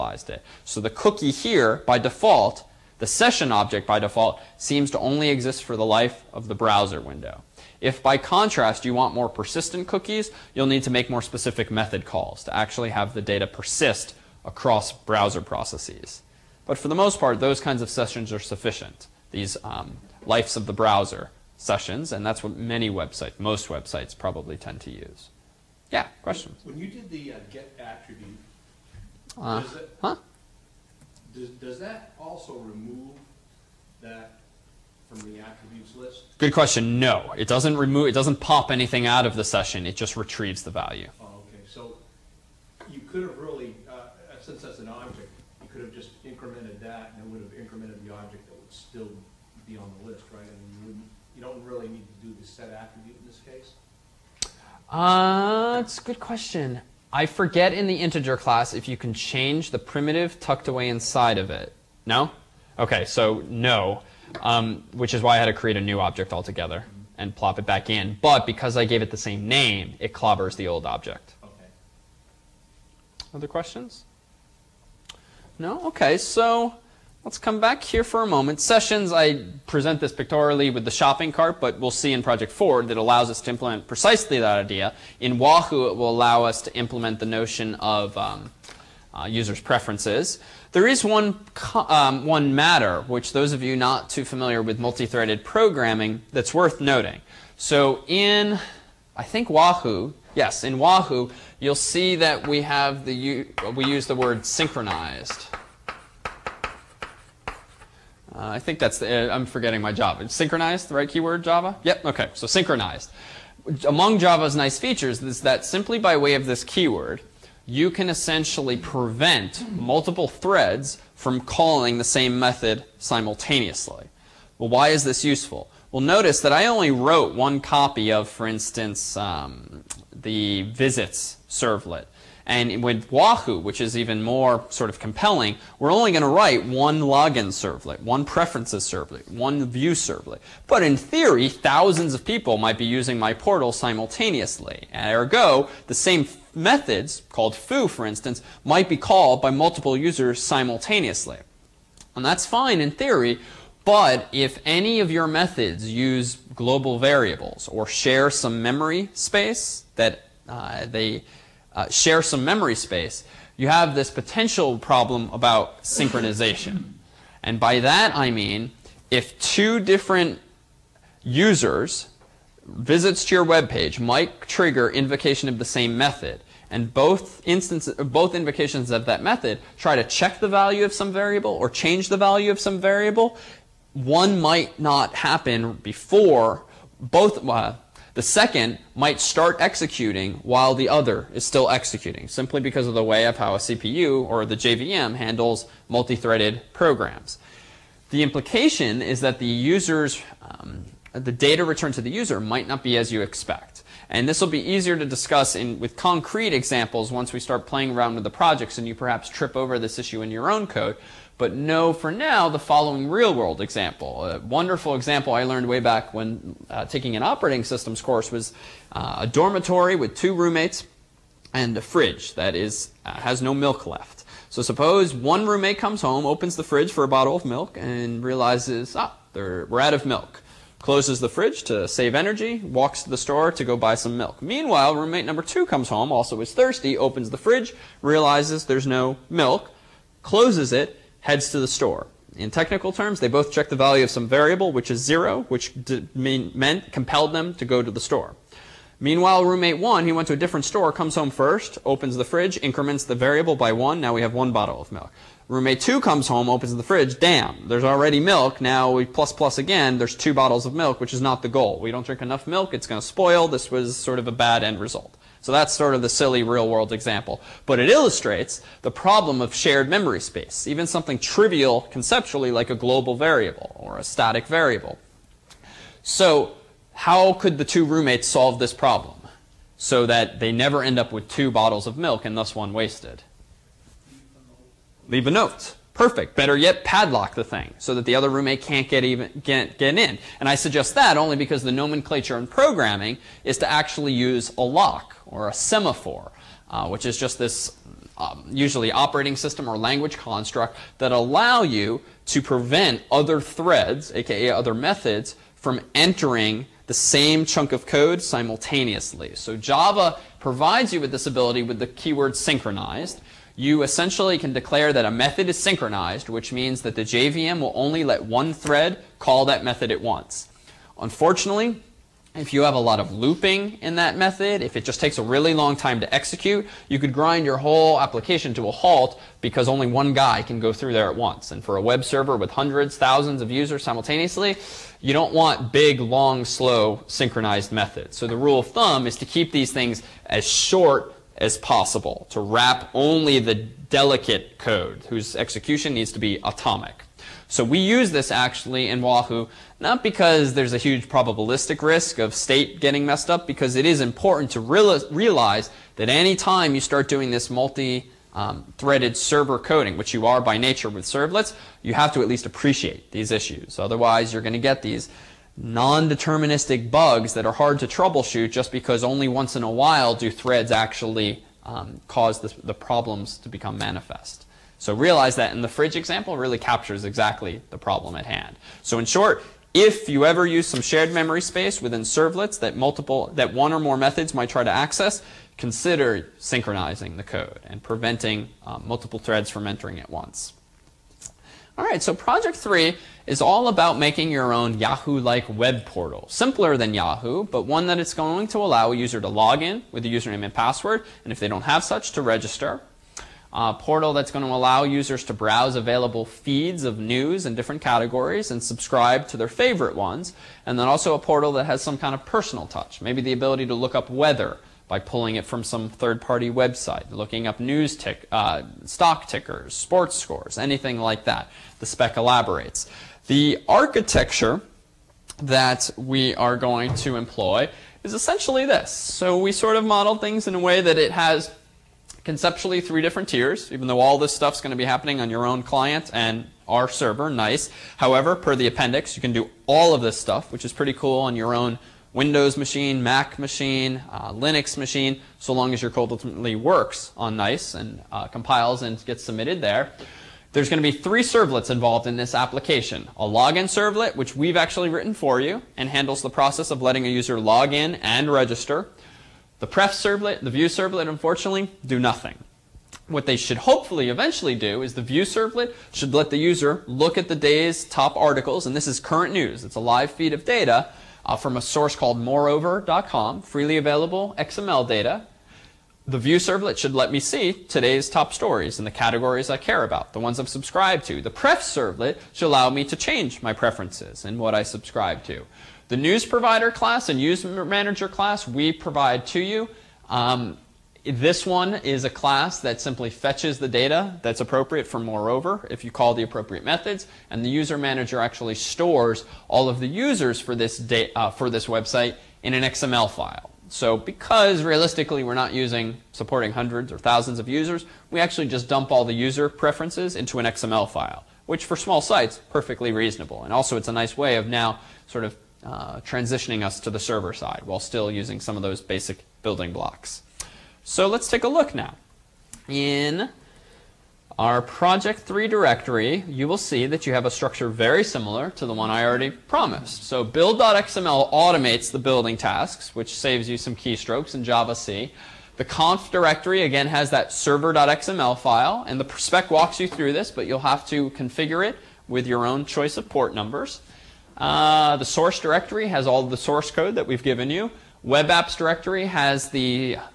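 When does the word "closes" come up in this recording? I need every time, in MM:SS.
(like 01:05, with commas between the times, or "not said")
03:50, 04:00.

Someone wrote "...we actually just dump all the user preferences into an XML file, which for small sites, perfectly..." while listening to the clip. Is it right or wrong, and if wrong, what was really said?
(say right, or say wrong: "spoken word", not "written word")
right.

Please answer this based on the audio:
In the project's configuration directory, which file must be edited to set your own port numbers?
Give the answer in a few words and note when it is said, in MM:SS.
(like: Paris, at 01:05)
server.xml, at 08:57.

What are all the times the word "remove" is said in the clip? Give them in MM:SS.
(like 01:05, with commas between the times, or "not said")
00:32, 00:37.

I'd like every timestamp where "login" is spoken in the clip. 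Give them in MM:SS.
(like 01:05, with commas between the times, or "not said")
02:17, 07:33.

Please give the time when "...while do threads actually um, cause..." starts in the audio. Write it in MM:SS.
06:09.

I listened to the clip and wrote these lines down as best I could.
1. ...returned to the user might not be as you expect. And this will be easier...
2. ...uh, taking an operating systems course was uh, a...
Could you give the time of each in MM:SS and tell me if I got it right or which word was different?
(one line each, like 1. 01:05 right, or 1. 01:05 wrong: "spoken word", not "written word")
1. 03:21 right
2. 03:36 right.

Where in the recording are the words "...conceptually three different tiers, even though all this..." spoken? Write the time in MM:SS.
07:12.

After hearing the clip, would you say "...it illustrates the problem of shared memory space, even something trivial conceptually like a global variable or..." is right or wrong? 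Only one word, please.
right.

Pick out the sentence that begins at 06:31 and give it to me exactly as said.
All right, so project three is all about making your own Yahoo-like web portal.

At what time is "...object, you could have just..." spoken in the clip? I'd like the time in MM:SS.
00:44.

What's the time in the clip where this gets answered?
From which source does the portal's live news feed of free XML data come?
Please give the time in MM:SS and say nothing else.
07:52.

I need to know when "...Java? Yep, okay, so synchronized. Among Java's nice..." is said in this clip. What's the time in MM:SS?
01:51.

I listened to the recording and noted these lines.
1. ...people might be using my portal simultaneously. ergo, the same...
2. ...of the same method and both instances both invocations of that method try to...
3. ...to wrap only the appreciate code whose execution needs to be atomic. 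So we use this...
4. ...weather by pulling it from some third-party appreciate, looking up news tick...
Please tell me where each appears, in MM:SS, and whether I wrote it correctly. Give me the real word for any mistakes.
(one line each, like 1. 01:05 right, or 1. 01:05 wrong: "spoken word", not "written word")
1. 02:22 right
2. 02:55 right
3. 05:42 wrong: "delicate", not "appreciate"
4. 06:54 wrong: "website", not "appreciate".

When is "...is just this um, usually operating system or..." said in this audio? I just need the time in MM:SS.
04:57.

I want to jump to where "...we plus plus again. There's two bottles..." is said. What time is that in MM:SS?
04:18.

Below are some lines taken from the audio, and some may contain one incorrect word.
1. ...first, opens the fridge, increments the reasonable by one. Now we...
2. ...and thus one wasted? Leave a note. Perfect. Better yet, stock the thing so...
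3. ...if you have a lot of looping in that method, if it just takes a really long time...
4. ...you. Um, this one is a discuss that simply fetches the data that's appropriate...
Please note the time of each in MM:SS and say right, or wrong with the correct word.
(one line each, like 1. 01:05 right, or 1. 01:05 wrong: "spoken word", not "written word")
1. 04:11 wrong: "variable", not "reasonable"
2. 04:42 wrong: "padlock", not "stock"
3. 05:22 right
4. 08:09 wrong: "class", not "discuss".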